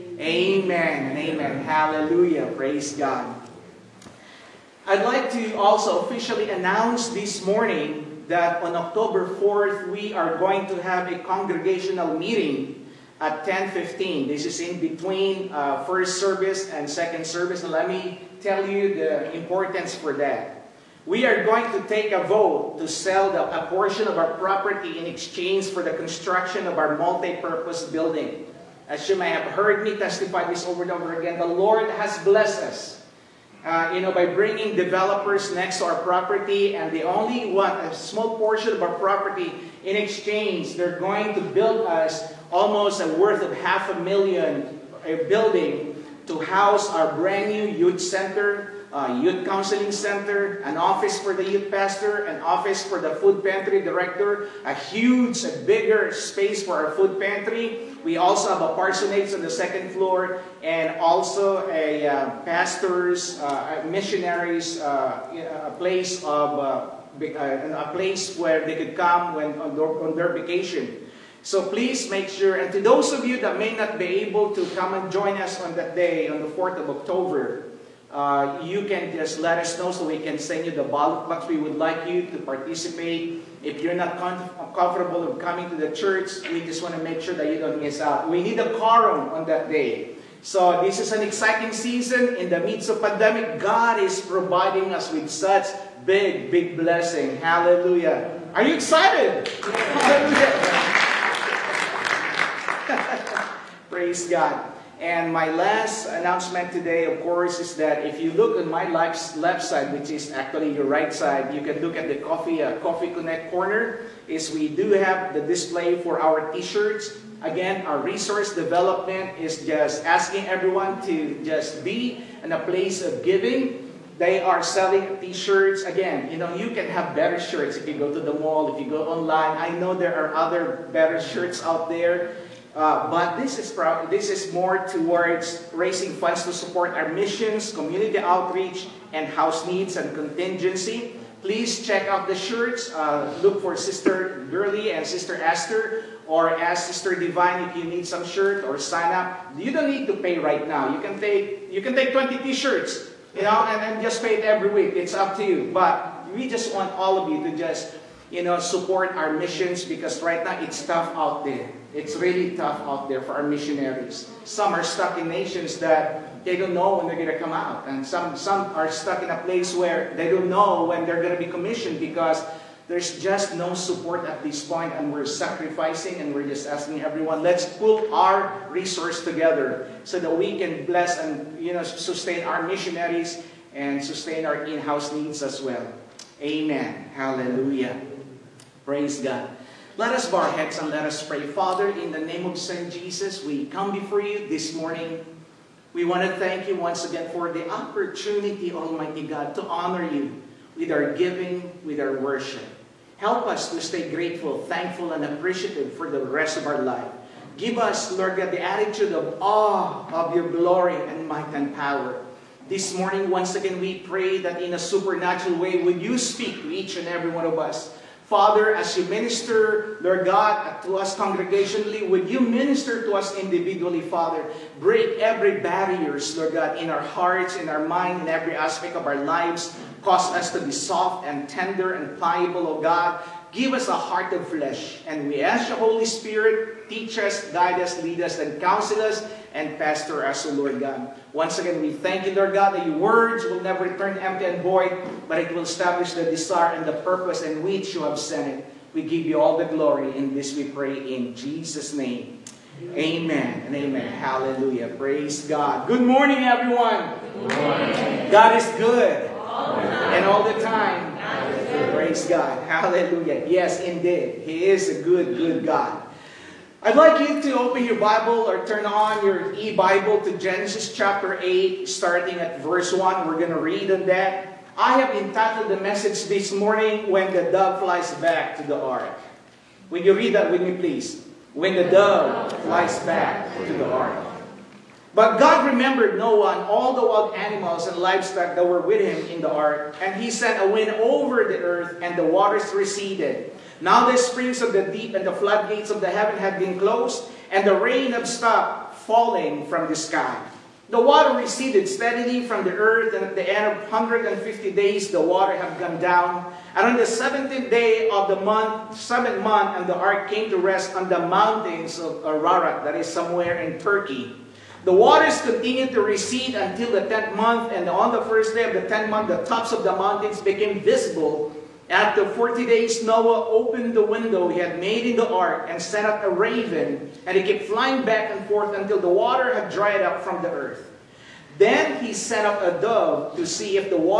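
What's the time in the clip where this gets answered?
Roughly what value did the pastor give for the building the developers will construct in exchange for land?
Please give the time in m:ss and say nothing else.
0:43.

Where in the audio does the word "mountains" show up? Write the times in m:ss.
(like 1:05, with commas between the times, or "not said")
5:11, 5:19.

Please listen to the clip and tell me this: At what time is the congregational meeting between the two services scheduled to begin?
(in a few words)
10:15.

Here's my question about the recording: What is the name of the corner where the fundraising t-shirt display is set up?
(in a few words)
Coffee Connect.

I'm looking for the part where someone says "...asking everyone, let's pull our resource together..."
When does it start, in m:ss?
2:56.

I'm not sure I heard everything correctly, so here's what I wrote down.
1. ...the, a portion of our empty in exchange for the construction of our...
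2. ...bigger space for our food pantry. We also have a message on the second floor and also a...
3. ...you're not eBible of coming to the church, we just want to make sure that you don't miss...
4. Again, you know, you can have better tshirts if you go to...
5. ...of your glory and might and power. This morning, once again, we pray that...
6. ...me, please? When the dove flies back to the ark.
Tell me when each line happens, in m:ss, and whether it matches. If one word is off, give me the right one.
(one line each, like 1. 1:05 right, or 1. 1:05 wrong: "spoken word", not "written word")
1. 0:23 wrong: "property", not "empty"
2. 0:55 wrong: "parsonage", not "message"
3. 1:23 wrong: "comfortable", not "eBible"
4. 2:05 wrong: "shirts", not "tshirts"
5. 3:30 right
6. 4:40 right.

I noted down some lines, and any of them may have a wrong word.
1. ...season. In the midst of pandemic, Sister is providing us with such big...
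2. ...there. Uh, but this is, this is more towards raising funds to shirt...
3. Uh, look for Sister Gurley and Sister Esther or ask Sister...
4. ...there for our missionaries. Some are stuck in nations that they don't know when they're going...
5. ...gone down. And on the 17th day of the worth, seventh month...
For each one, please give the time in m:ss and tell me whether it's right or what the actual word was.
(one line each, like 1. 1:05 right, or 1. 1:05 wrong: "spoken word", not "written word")
1. 1:31 wrong: "God", not "Sister"
2. 2:11 wrong: "support", not "shirt"
3. 2:22 right
4. 2:43 right
5. 5:05 wrong: "month", not "worth".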